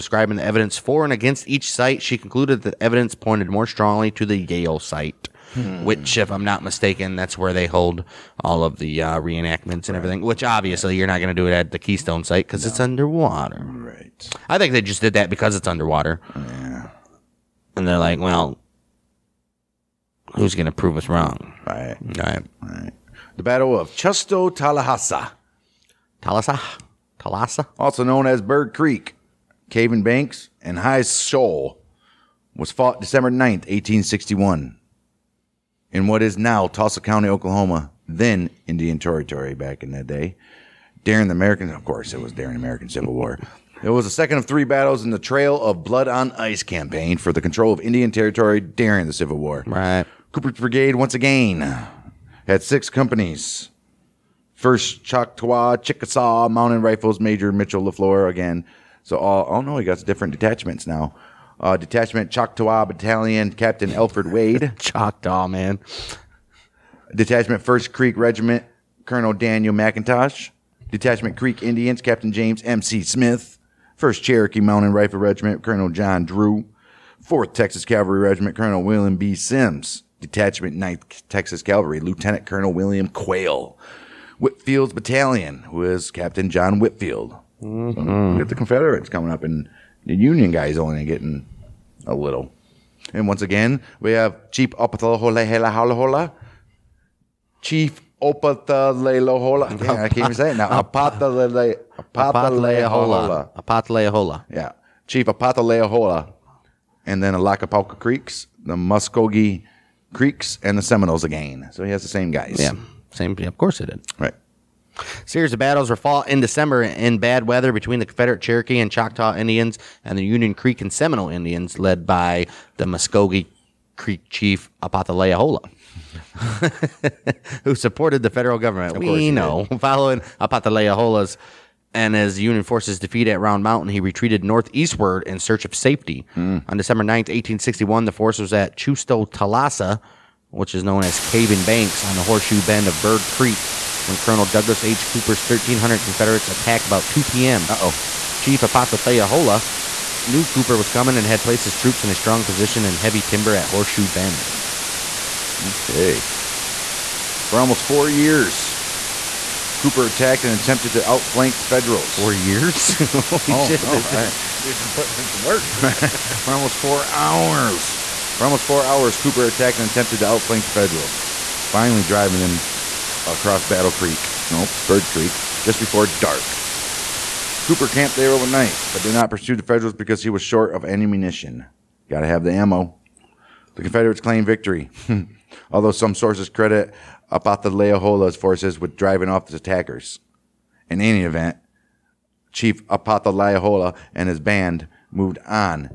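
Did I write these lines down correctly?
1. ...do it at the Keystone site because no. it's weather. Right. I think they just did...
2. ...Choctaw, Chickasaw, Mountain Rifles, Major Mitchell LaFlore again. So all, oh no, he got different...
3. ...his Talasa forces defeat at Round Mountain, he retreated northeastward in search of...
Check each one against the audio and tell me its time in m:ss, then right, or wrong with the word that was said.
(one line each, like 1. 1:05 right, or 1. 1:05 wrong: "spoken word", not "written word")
1. 0:11 wrong: "underwater", not "weather"
2. 0:55 right
3. 2:12 wrong: "Union", not "Talasa".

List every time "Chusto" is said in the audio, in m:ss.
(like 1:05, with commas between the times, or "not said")
0:23, 2:18.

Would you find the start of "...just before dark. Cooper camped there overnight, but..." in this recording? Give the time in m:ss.
2:55.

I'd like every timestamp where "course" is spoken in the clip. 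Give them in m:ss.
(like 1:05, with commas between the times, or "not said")
0:41, 1:53.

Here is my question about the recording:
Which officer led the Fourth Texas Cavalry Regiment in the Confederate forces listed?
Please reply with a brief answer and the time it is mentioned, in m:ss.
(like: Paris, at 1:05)
Colonel William B. Sims, at 1:18.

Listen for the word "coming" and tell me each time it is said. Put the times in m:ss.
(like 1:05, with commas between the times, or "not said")
1:29, 2:30.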